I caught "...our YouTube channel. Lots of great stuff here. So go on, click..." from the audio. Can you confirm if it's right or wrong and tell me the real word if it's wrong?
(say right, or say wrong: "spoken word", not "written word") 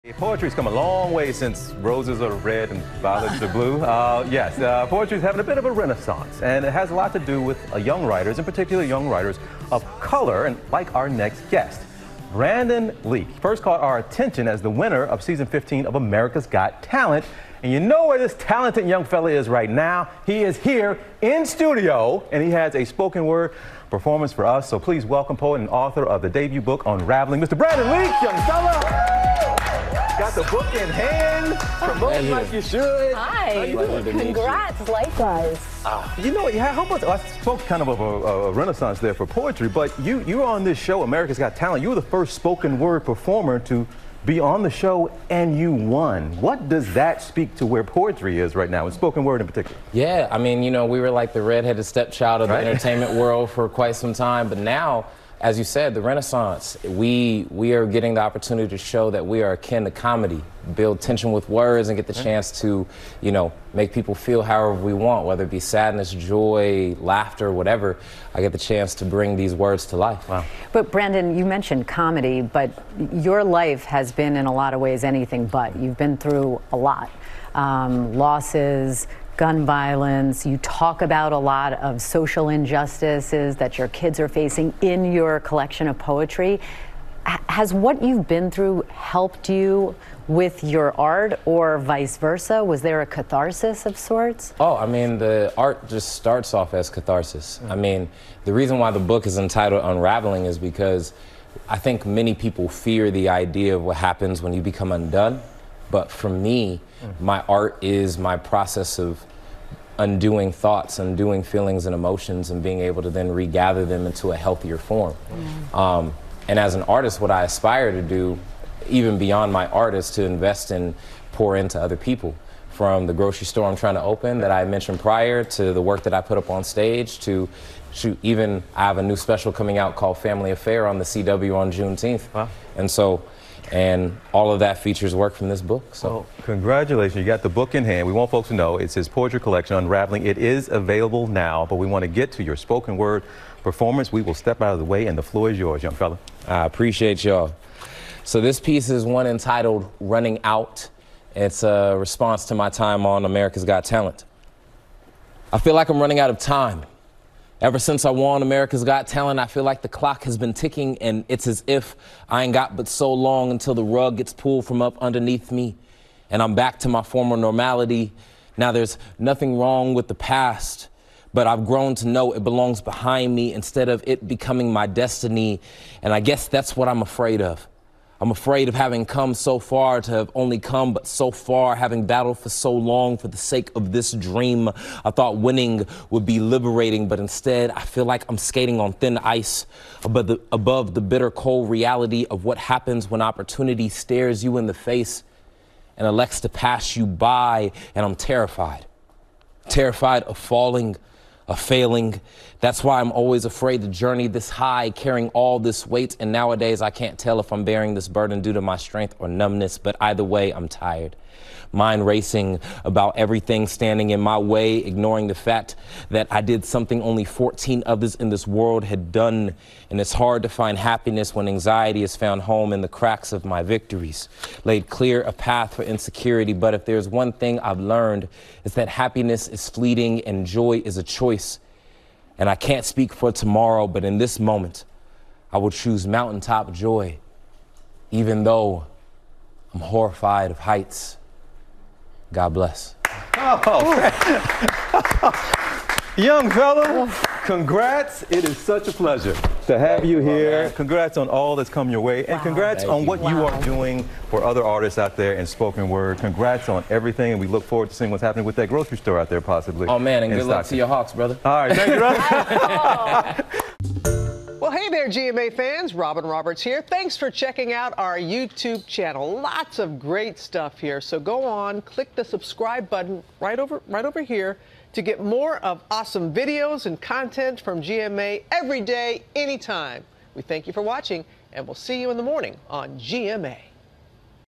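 right.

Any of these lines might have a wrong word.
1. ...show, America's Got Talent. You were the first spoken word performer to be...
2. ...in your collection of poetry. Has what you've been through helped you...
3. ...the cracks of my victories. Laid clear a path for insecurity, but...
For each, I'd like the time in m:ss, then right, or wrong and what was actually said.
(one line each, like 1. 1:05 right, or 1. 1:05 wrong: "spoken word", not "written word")
1. 0:40 right
2. 1:24 right
3. 3:42 right.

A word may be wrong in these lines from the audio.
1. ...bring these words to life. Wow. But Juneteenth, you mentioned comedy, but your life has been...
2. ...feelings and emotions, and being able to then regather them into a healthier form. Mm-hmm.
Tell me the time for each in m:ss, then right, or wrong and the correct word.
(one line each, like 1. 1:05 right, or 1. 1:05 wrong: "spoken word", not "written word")
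1. 1:09 wrong: "Brandon", not "Juneteenth"
2. 1:51 right.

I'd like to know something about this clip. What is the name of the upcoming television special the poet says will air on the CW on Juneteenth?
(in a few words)
Family Affair.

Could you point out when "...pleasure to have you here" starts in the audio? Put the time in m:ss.
4:08.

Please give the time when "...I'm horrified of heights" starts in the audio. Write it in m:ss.
3:59.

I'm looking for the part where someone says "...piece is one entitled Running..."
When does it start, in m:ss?
2:28.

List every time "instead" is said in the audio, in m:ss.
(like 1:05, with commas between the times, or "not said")
2:53, 3:07.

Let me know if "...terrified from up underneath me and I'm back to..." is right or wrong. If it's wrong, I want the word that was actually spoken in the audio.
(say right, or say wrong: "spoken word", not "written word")
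wrong: "pulled", not "terrified".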